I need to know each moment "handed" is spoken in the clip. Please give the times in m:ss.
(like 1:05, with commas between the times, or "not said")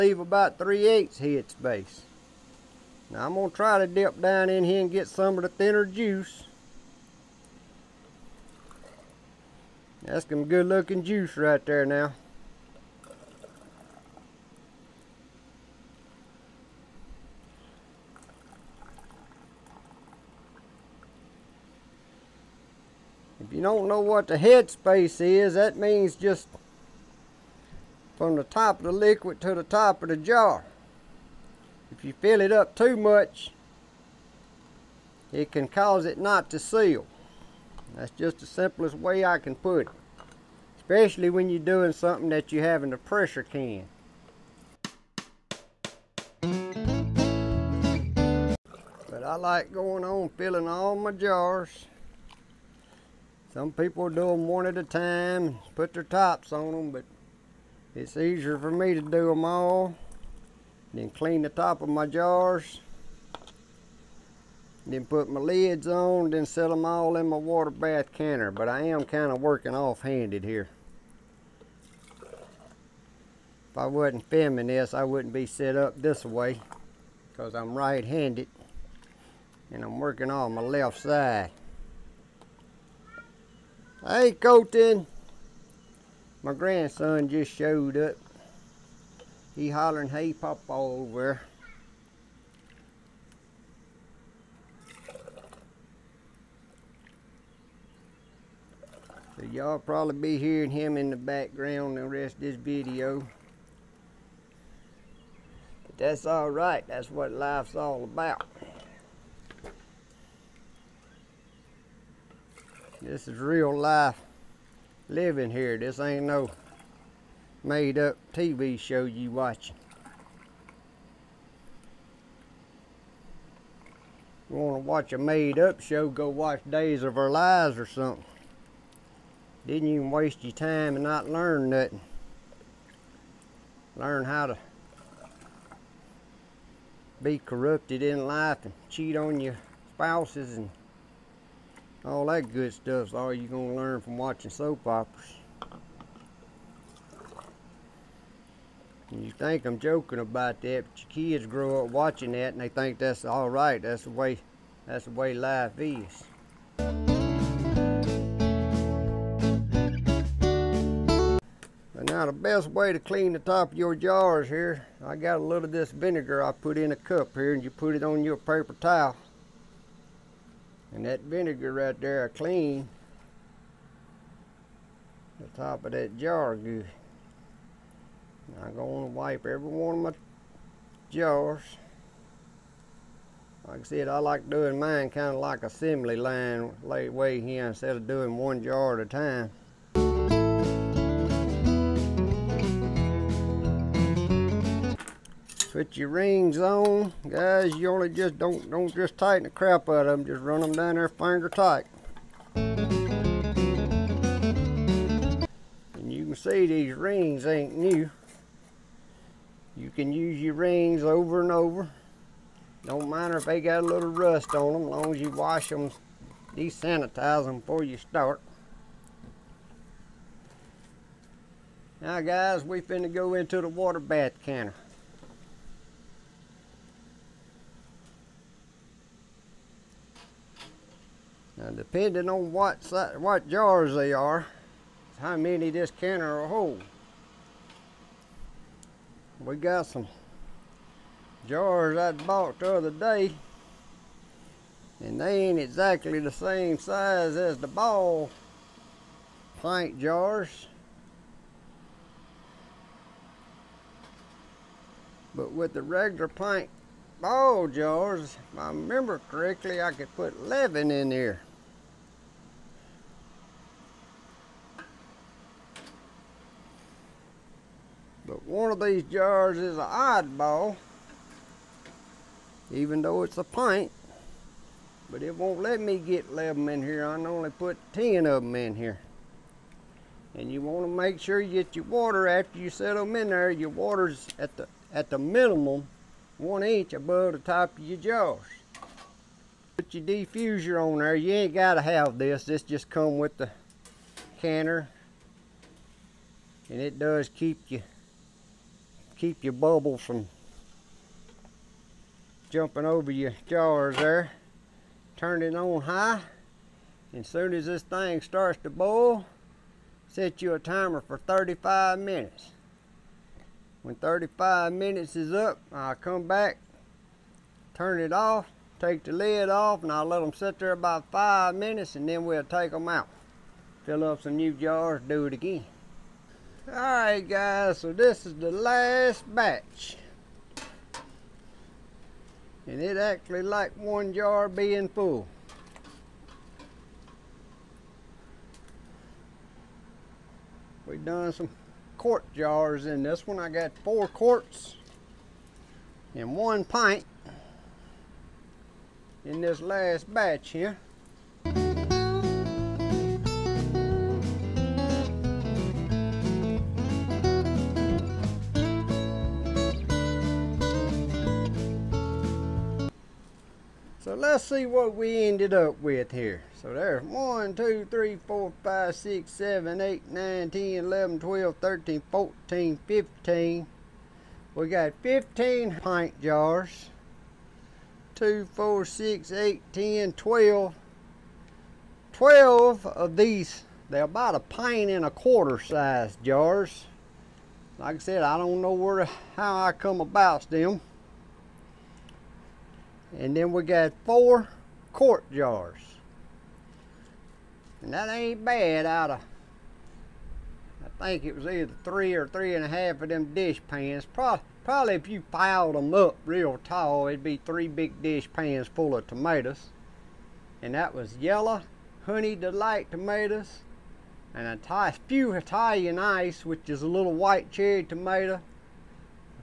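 1:09, 1:17.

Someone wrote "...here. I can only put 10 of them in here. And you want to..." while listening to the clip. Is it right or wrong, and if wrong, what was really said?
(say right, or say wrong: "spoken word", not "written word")
right.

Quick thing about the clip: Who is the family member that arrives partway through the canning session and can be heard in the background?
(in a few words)
Colton.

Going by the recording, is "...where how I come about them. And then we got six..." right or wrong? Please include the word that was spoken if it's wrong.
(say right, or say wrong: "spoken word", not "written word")
wrong: "four", not "six".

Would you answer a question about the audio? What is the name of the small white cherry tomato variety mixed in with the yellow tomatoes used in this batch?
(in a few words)
Italian ice.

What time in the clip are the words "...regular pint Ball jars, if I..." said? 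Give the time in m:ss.
4:15.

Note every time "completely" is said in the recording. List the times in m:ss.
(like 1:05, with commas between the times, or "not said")
not said.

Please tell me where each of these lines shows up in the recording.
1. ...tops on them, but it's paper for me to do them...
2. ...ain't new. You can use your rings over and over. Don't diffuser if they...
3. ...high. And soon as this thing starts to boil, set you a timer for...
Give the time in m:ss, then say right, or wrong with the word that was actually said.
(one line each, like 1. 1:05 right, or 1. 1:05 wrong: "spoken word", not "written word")
1. 0:56 wrong: "easier", not "paper"
2. 3:27 wrong: "matter", not "diffuser"
3. 5:05 right.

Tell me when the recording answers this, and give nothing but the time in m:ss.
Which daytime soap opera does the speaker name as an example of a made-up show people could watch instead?
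2:06.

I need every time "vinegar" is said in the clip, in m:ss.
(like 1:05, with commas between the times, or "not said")
2:45, 2:51.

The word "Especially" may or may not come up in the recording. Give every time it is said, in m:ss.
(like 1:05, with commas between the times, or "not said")
0:40.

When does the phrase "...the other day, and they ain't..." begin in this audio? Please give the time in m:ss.
4:02.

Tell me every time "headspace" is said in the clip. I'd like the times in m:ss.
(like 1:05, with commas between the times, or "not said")
0:01, 0:24.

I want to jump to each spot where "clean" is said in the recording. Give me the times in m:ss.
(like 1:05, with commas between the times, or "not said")
1:01, 2:42, 2:52.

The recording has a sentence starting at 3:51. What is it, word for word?
Now, depending on what, what jars they are, how many this canner will hold.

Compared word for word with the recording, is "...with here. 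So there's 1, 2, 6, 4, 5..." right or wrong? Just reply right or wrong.
wrong.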